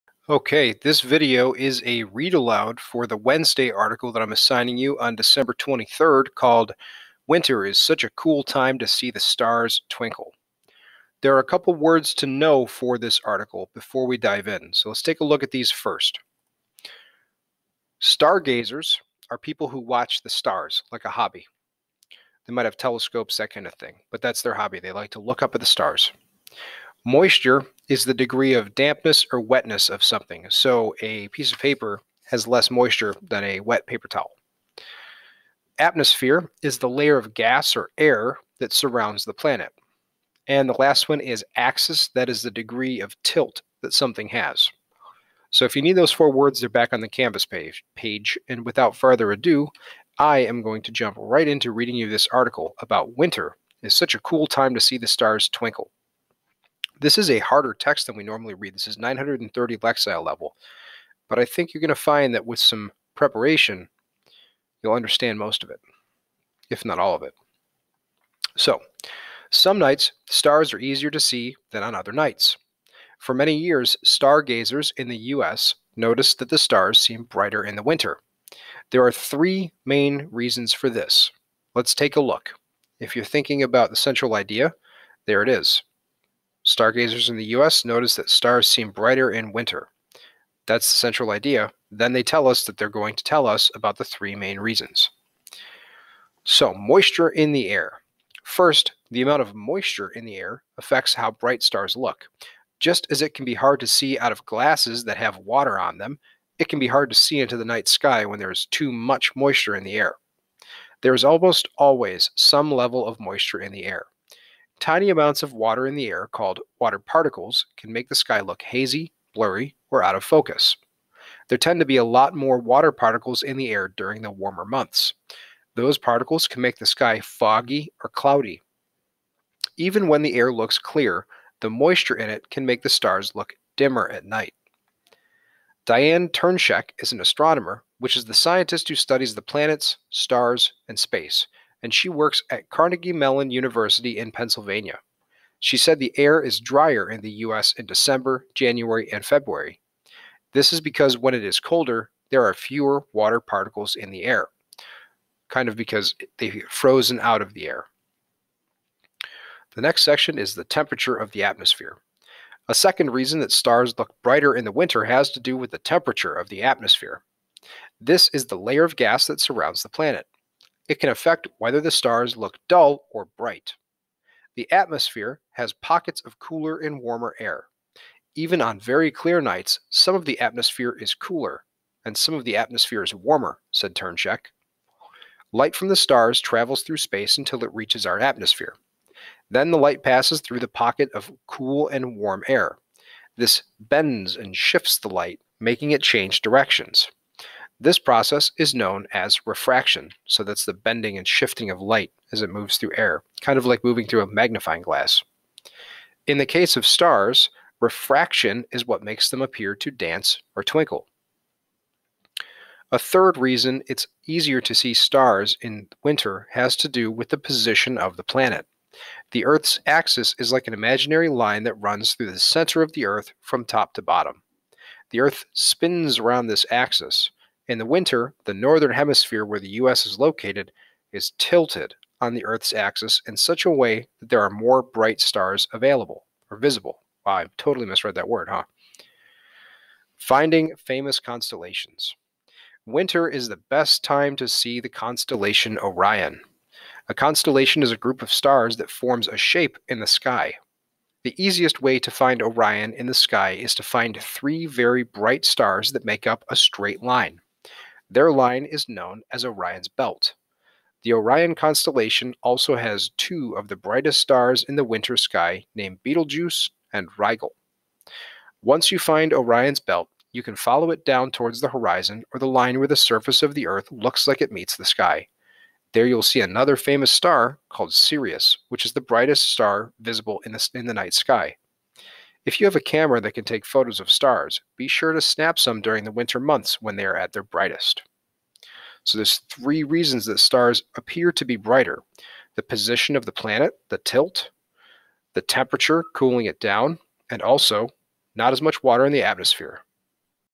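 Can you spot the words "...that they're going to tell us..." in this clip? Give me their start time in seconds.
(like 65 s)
92 s.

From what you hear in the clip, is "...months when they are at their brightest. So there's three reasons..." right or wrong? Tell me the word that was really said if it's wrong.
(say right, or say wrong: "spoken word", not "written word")
right.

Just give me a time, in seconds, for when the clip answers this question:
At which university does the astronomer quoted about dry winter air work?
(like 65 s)
142 s.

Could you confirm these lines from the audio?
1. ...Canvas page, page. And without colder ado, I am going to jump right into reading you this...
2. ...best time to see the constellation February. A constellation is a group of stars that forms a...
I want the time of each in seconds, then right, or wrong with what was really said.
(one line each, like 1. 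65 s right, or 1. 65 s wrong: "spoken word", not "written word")
1. 47 s wrong: "further", not "colder"
2. 243 s wrong: "Orion", not "February".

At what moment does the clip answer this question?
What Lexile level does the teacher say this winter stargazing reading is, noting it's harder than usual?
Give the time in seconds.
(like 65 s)
58 s.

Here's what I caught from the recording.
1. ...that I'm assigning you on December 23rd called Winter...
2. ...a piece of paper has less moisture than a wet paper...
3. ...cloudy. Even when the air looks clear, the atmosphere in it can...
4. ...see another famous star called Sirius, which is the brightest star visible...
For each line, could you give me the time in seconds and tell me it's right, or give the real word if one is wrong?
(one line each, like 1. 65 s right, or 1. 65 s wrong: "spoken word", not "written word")
1. 4 s right
2. 31 s right
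3. 128 s wrong: "moisture", not "atmosphere"
4. 276 s right.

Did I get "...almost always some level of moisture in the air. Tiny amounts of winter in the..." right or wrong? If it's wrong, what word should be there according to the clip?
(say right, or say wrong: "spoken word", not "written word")
wrong: "water", not "winter".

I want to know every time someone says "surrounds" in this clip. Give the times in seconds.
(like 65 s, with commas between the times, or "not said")
38 s, 169 s.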